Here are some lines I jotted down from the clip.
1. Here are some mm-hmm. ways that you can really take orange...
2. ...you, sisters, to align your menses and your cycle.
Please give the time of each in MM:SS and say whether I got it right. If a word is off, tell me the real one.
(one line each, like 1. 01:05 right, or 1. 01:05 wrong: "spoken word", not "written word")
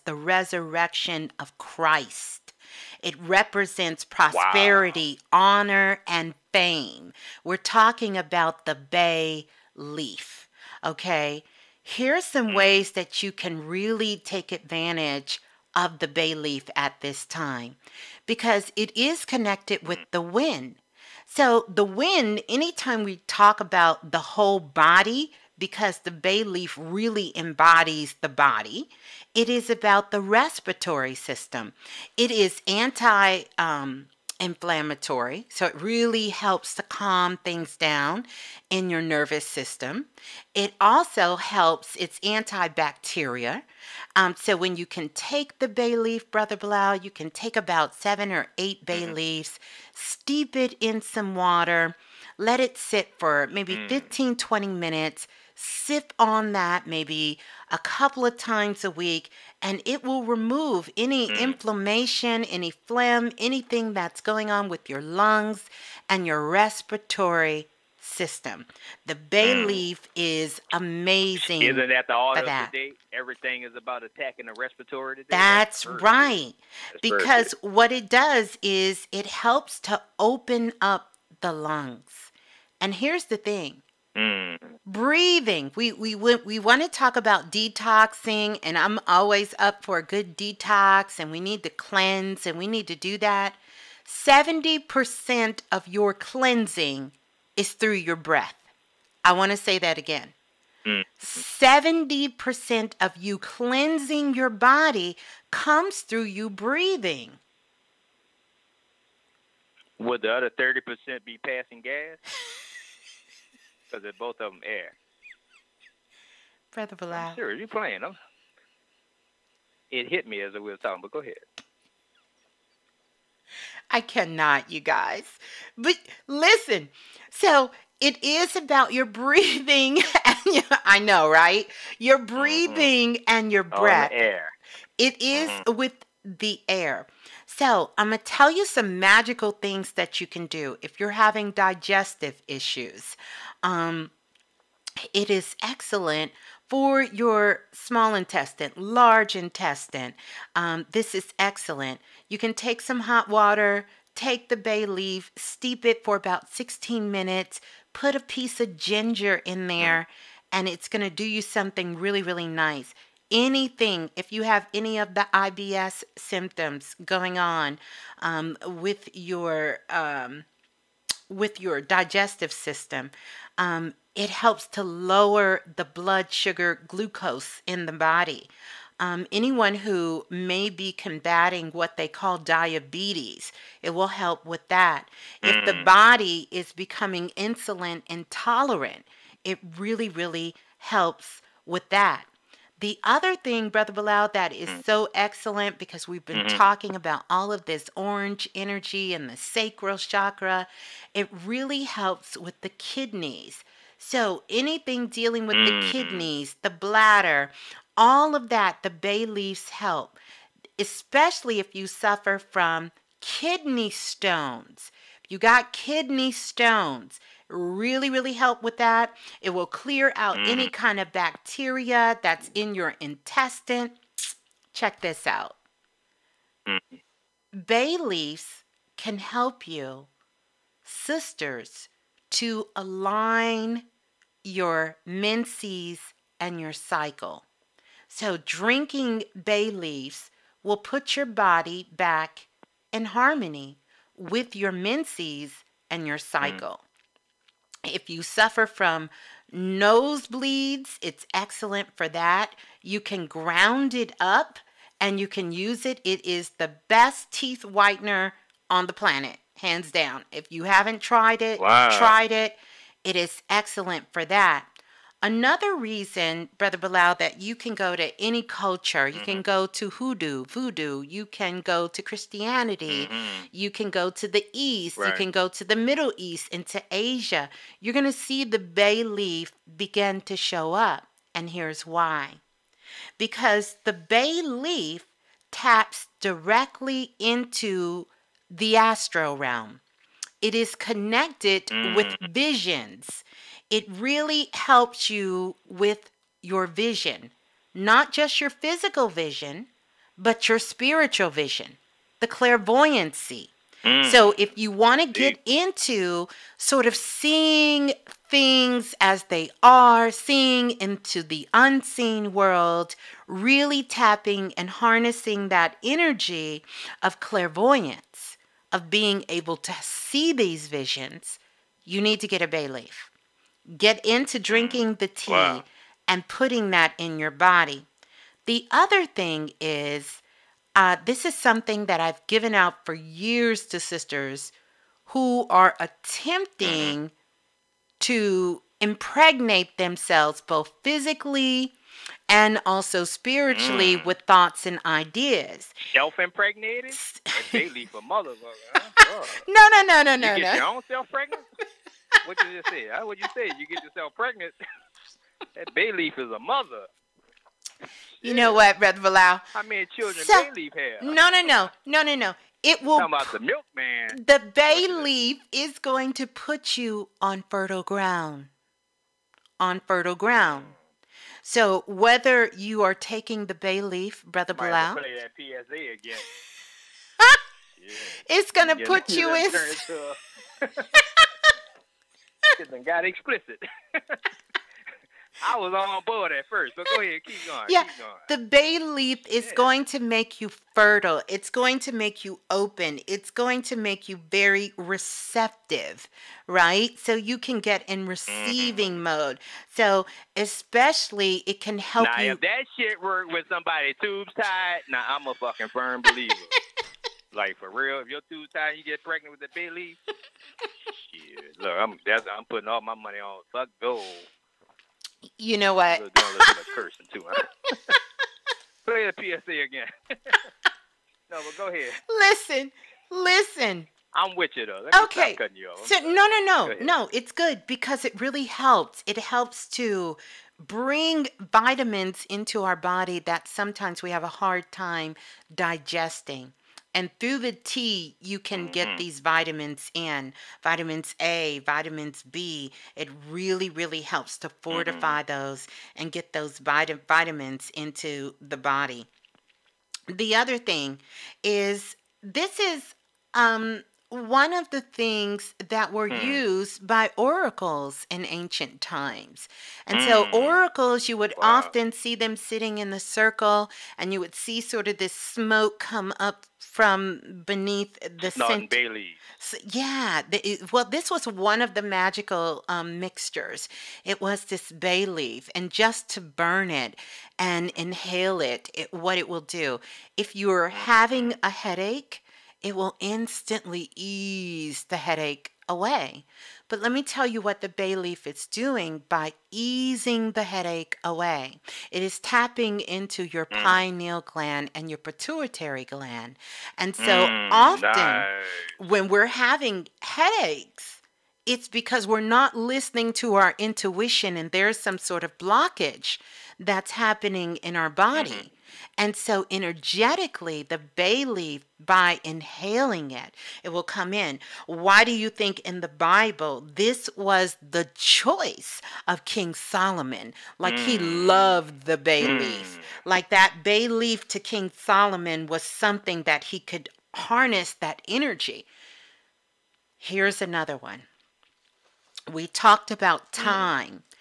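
1. 00:11 wrong: "advantage", not "orange"
2. 03:49 right.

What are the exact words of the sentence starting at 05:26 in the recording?
and putting that in your body.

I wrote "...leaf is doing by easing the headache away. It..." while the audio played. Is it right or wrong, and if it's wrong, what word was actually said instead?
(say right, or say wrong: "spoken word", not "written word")
right.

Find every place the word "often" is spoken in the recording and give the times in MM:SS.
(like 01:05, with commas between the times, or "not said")
07:41, 08:17.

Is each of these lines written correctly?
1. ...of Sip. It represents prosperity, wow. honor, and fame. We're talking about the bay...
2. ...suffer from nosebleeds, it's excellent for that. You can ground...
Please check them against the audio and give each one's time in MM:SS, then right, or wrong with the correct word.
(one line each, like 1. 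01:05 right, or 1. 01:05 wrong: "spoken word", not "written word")
1. 00:01 wrong: "Christ", not "Sip"
2. 04:08 right.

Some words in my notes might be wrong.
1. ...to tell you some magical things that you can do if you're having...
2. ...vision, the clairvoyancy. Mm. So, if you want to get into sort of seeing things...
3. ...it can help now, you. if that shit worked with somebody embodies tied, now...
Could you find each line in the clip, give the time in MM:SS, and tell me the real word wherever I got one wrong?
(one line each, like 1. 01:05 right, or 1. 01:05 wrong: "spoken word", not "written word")
1. 02:18 right
2. 05:01 right
3. 06:41 wrong: "tubes", not "embodies".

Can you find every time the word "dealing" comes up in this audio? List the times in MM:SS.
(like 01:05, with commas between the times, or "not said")
03:25.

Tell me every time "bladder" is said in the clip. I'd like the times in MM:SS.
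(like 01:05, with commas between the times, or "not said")
03:26.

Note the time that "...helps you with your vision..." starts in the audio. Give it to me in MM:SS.
04:54.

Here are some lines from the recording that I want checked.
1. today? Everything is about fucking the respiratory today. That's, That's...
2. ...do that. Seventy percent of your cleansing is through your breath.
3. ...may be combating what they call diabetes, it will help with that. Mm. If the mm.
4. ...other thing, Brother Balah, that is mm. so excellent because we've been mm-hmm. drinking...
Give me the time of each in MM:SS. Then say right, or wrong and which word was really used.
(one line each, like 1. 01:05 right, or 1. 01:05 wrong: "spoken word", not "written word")
1. 01:12 wrong: "attacking", not "fucking"
2. 01:32 right
3. 03:00 right
4. 03:13 wrong: "talking", not "drinking".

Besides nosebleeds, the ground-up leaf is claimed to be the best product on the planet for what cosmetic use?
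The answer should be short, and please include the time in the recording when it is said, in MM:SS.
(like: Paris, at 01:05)
teeth whitener, at 04:17.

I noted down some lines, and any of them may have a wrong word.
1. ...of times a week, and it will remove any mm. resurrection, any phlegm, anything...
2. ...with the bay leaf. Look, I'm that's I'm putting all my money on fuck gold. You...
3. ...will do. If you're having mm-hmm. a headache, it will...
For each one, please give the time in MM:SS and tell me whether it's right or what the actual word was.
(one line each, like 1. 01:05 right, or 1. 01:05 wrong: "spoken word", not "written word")
1. 00:58 wrong: "inflammation", not "resurrection"
2. 06:49 right
3. 07:59 right.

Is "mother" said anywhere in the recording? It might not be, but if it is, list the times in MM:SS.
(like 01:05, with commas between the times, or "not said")
05:48, 05:56.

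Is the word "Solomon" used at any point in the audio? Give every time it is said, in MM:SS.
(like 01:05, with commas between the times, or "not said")
08:39, 08:44.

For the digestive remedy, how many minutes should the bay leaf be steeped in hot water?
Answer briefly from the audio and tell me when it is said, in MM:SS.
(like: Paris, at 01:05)
16 minutes, at 02:36.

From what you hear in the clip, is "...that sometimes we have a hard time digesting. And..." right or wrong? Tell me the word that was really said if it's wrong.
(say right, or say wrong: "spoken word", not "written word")
right.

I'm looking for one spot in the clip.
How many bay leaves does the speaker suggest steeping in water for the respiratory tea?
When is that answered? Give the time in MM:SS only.
00:47.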